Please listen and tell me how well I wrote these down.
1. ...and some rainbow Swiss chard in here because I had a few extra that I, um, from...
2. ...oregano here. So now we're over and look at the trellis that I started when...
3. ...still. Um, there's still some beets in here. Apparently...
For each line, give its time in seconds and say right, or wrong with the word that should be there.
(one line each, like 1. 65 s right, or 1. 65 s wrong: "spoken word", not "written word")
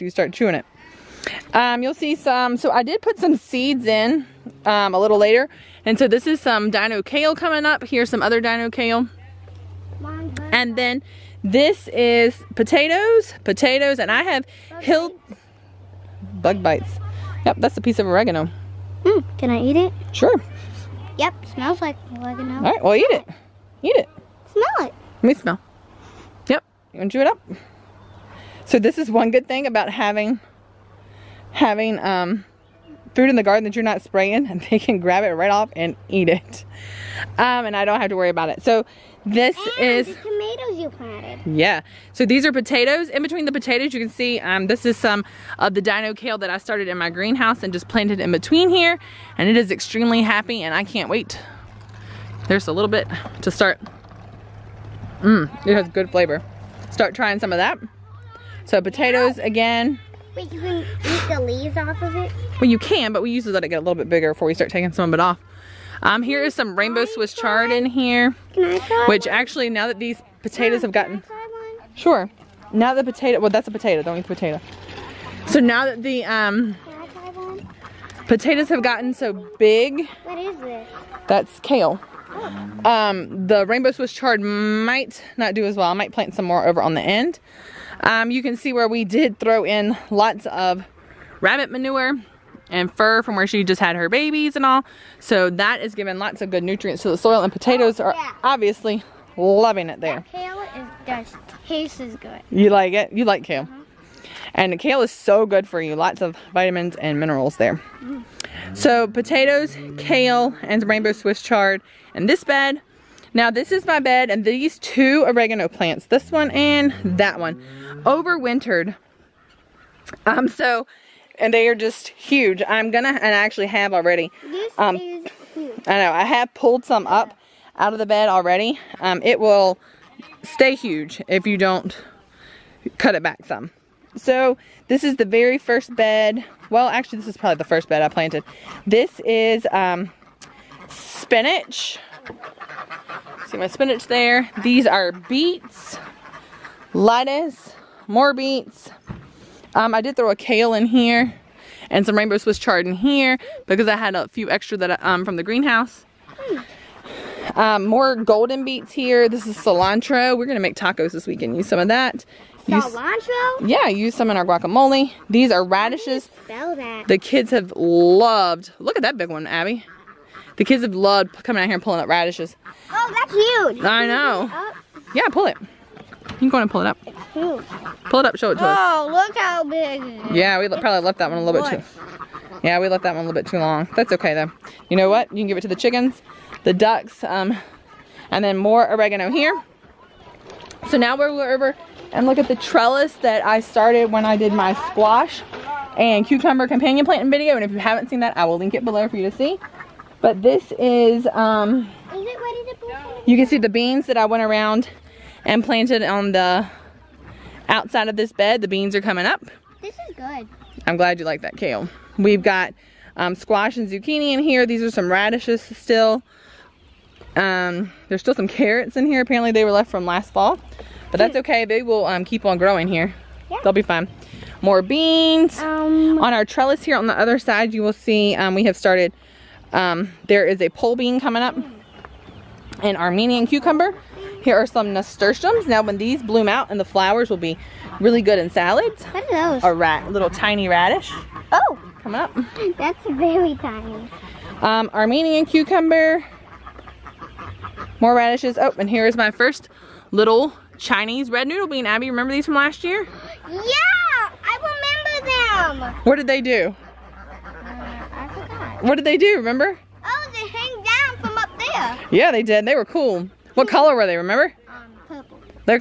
1. 151 s right
2. 188 s right
3. 215 s wrong: "carrots", not "beets".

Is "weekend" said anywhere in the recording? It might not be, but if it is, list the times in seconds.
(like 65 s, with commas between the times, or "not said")
161 s.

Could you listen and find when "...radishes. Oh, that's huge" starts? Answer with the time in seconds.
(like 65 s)
172 s.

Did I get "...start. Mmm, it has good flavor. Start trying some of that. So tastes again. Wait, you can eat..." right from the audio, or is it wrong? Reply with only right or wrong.
wrong.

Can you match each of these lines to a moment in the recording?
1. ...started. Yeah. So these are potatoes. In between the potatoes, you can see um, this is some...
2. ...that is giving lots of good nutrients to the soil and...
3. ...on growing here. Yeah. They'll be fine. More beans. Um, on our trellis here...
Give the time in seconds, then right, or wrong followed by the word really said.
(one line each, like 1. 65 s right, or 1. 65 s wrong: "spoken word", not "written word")
1. 40 s wrong: "planted", not "started"
2. 95 s right
3. 222 s right.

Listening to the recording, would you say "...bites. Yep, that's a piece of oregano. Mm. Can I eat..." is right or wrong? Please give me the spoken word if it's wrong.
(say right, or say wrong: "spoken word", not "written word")
right.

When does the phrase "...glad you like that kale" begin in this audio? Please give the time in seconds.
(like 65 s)
210 s.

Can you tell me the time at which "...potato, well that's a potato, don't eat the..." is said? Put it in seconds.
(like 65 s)
73 s.